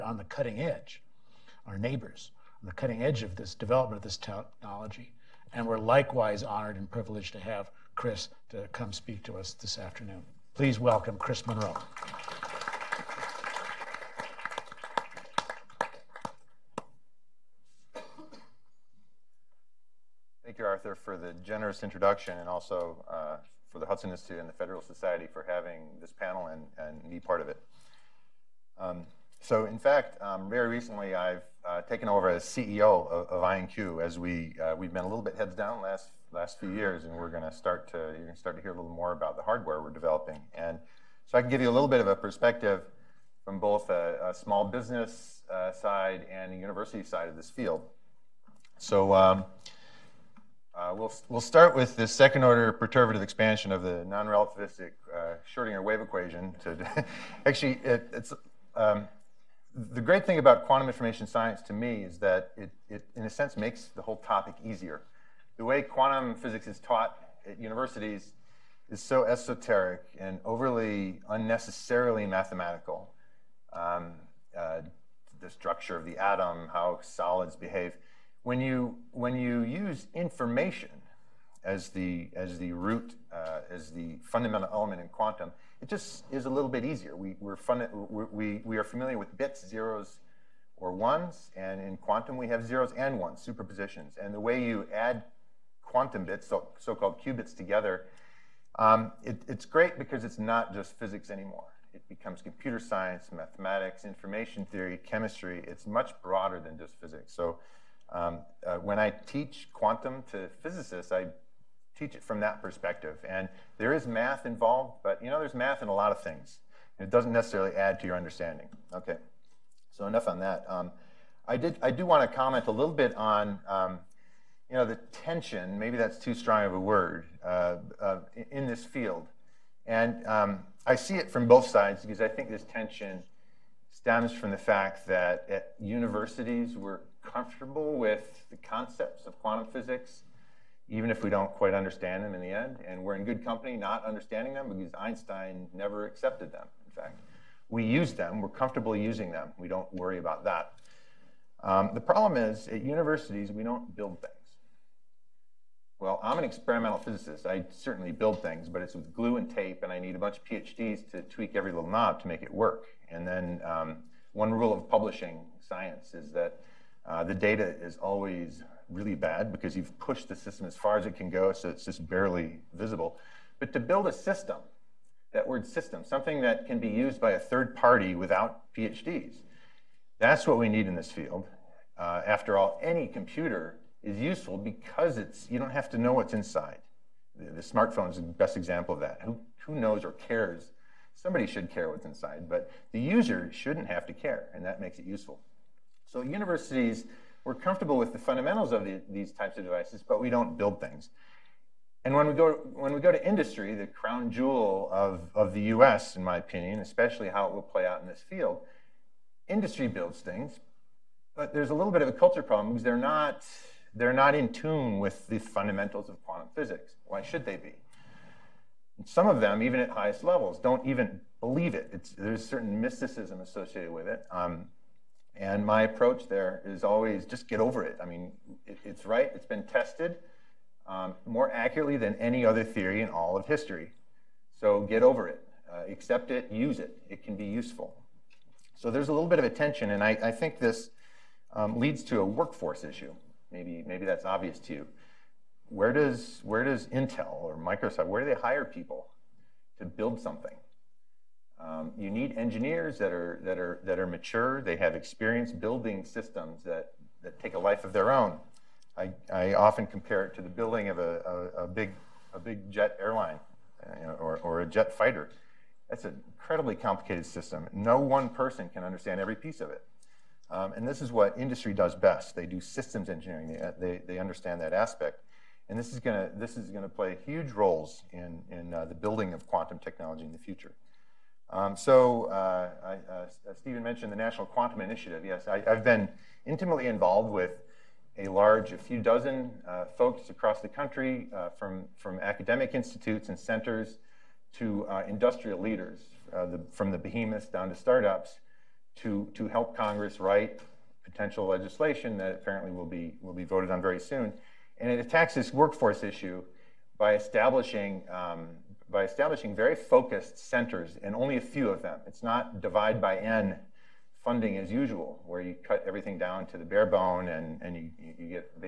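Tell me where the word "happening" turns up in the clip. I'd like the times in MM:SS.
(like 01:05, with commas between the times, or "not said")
not said.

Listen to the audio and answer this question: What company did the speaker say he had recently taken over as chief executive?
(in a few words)
IonQ.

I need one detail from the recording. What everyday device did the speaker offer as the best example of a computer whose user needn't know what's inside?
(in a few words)
smartphone.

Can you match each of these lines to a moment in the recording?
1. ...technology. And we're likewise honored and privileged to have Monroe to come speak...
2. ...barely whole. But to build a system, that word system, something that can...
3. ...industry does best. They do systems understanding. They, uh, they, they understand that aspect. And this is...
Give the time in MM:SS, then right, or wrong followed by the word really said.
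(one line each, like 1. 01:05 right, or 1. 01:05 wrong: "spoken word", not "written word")
1. 00:04 wrong: "Chris", not "Monroe"
2. 02:52 wrong: "visible", not "whole"
3. 04:31 wrong: "engineering", not "understanding".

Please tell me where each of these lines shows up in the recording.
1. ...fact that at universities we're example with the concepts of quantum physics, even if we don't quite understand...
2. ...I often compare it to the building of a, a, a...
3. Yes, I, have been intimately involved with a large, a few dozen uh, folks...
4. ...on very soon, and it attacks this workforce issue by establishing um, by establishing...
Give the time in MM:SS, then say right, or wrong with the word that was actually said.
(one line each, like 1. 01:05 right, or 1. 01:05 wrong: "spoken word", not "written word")
1. 02:14 wrong: "comfortable", not "example"
2. 04:19 right
3. 04:45 right
4. 05:03 right.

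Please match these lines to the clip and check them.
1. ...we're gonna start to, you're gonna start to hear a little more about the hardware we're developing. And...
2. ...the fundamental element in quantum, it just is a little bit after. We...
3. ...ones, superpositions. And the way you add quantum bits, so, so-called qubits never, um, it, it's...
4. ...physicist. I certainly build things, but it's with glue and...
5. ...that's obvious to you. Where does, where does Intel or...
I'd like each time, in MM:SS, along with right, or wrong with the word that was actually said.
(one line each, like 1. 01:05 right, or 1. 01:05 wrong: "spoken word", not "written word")
1. 00:37 right
2. 01:23 wrong: "easier", not "after"
3. 01:33 wrong: "together", not "never"
4. 02:36 right
5. 04:04 right.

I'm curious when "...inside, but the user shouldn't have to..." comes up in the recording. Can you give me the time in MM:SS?
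03:12.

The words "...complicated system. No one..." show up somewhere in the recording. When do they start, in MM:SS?
04:26.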